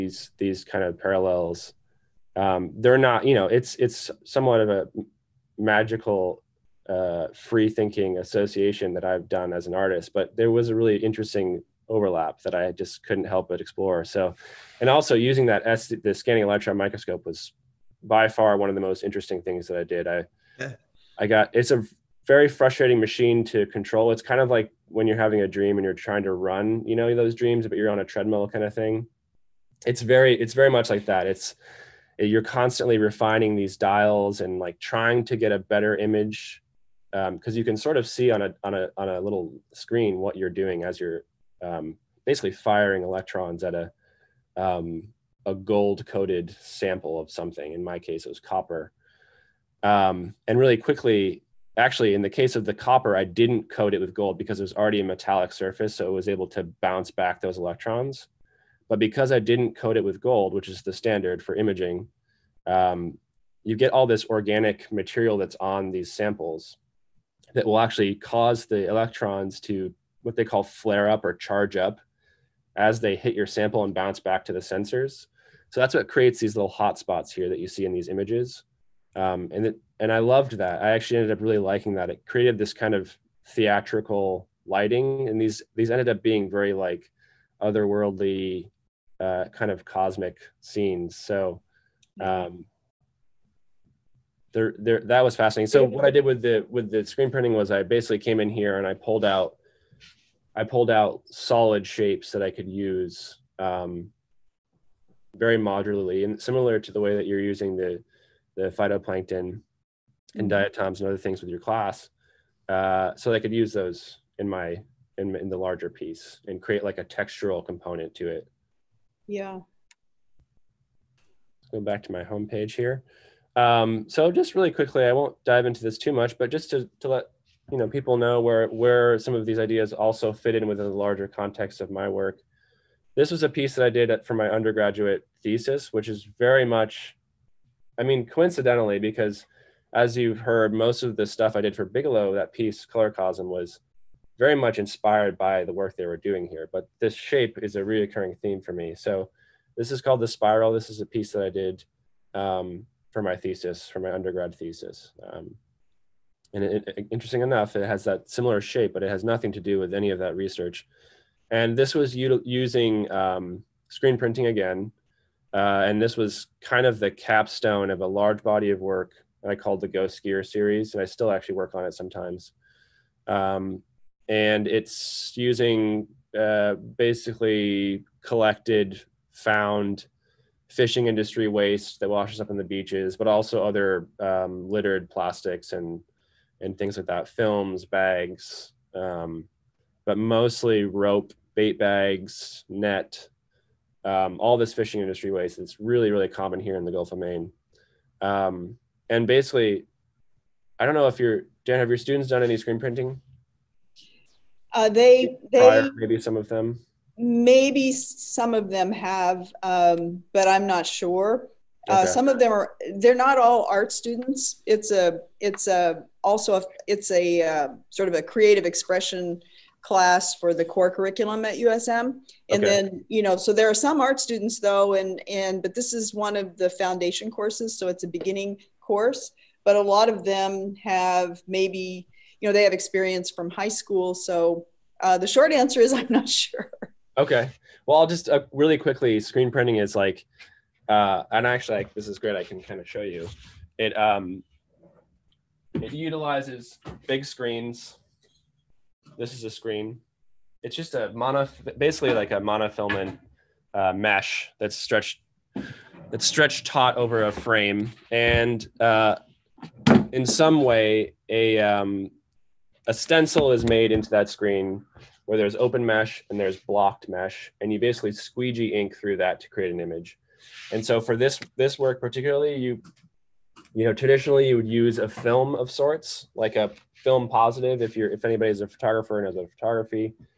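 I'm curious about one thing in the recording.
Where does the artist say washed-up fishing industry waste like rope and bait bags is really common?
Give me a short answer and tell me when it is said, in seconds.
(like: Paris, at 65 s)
Gulf of Maine, at 196 s.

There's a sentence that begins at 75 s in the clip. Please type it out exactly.
So that's what creates these little hot spots here that you see in these images.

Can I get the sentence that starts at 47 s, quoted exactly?
In my case, it was copper.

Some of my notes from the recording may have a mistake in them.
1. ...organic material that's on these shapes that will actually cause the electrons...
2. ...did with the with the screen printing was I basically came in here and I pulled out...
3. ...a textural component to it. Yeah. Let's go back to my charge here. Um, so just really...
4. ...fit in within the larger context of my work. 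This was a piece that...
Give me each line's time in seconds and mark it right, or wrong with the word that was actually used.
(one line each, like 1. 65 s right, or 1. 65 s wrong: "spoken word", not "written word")
1. 64 s wrong: "samples", not "shapes"
2. 96 s right
3. 116 s wrong: "homepage", not "charge"
4. 130 s right.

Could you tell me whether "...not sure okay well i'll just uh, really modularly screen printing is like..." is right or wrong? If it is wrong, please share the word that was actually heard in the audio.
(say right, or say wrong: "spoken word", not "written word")
wrong: "quickly", not "modularly".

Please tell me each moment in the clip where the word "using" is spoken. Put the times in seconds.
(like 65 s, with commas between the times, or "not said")
15 s, 107 s, 162 s, 175 s.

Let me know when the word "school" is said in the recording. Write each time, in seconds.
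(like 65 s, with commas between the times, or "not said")
233 s.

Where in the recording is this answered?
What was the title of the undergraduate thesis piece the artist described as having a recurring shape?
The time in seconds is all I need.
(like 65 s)
150 s.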